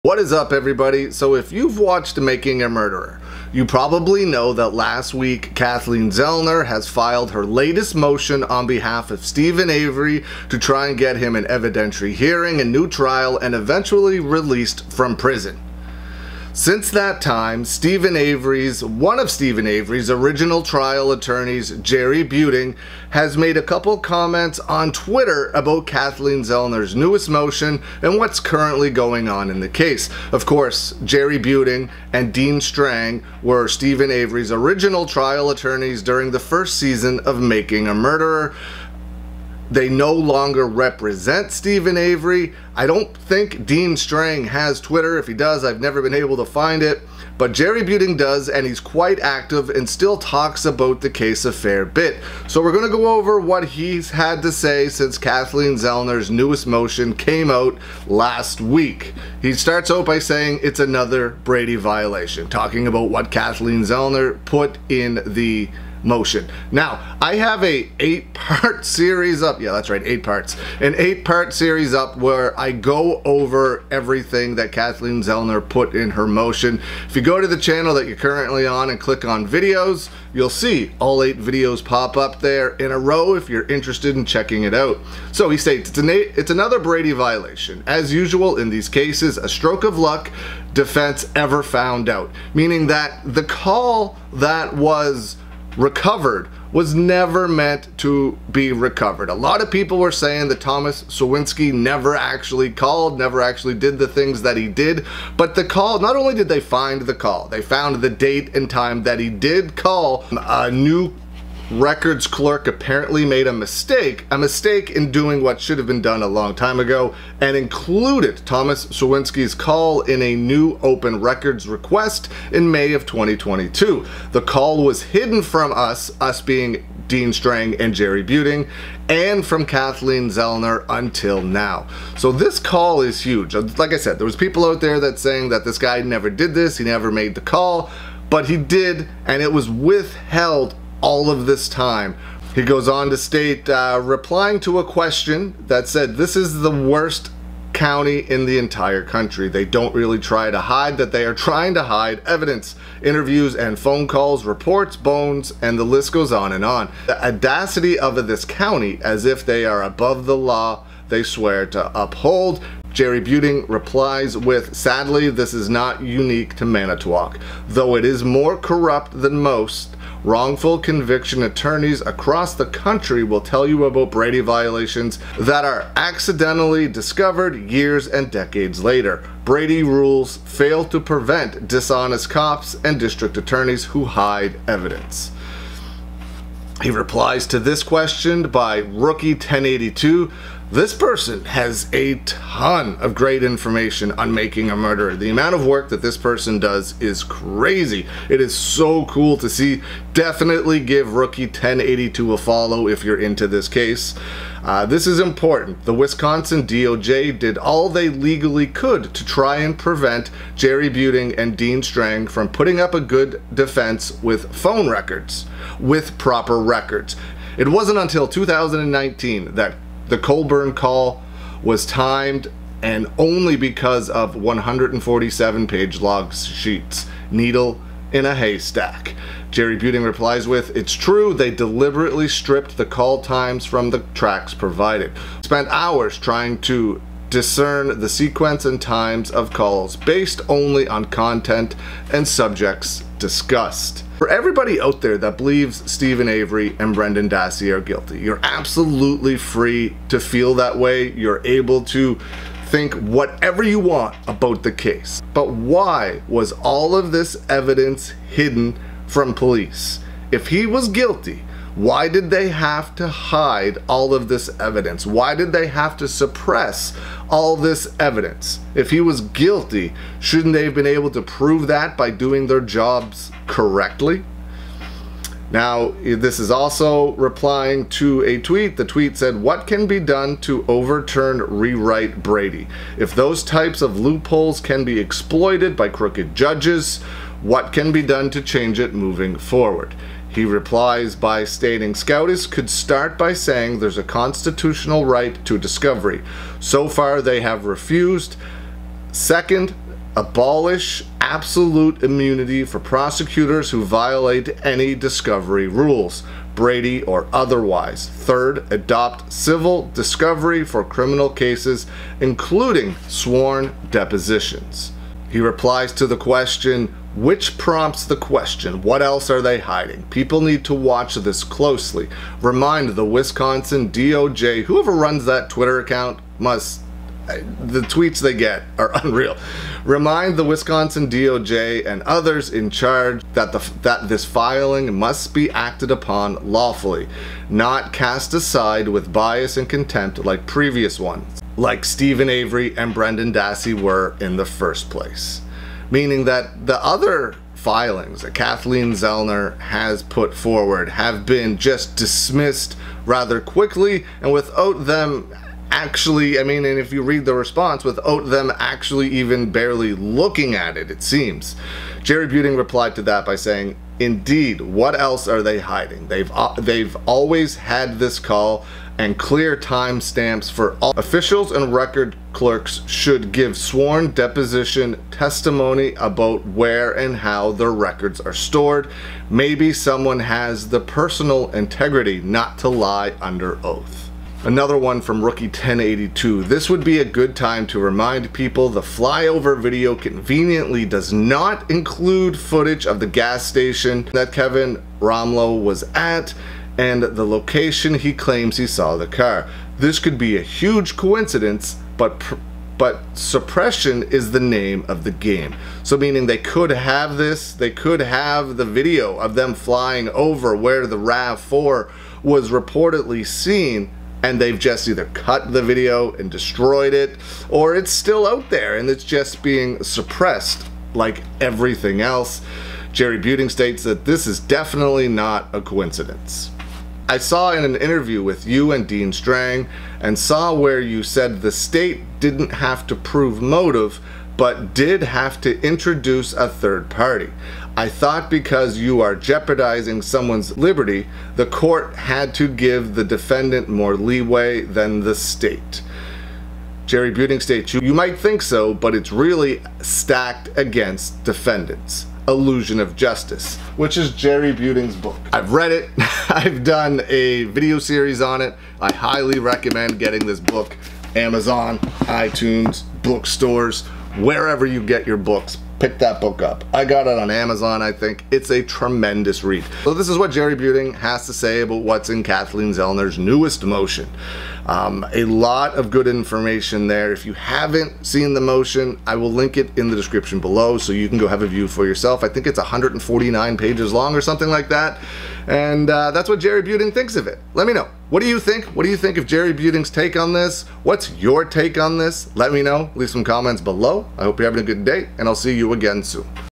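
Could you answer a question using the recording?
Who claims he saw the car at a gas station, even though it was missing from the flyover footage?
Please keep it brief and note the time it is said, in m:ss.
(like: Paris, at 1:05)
Kevin Rahmlow, at 6:34.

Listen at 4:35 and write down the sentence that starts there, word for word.
Now, this is also replying to a tweet.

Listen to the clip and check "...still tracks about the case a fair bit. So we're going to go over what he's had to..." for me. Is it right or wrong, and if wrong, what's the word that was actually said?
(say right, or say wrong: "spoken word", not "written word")
wrong: "talks", not "tracks".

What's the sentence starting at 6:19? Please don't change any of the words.
Maybe someone has the personal integrity not to lie under oath.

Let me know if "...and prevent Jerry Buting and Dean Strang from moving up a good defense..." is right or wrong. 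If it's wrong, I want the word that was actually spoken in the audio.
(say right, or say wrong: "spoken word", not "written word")
wrong: "putting", not "moving".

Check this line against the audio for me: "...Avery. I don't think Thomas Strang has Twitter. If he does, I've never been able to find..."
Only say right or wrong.
wrong.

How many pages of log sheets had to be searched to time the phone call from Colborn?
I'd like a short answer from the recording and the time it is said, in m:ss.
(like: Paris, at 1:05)
147, at 3:44.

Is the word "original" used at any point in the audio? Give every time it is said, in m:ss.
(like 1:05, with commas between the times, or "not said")
0:20, 0:34.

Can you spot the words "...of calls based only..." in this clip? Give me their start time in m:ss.
3:59.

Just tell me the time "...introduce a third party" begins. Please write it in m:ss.
7:15.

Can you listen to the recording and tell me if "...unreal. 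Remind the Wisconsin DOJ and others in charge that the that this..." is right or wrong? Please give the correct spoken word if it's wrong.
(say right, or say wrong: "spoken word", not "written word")
right.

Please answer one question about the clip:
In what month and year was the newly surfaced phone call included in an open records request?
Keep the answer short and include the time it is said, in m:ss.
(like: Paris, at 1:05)
May 2022, at 2:02.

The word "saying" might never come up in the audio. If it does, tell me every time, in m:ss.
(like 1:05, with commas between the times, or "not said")
1:00, 1:40, 2:15, 4:53, 6:03.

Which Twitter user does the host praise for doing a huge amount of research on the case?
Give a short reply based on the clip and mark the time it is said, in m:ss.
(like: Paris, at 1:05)
Rookie1082, at 3:08.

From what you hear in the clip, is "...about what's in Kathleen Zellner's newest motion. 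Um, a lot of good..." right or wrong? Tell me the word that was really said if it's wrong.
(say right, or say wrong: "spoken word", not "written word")
right.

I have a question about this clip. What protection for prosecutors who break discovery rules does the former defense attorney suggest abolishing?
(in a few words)
absolute immunity.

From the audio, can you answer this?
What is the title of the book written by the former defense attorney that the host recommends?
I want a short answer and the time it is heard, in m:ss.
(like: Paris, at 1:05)
Illusion of Justice, at 7:32.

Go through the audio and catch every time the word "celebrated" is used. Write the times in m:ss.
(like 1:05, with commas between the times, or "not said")
not said.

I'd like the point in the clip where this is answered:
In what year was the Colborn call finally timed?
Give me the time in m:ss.
3:38.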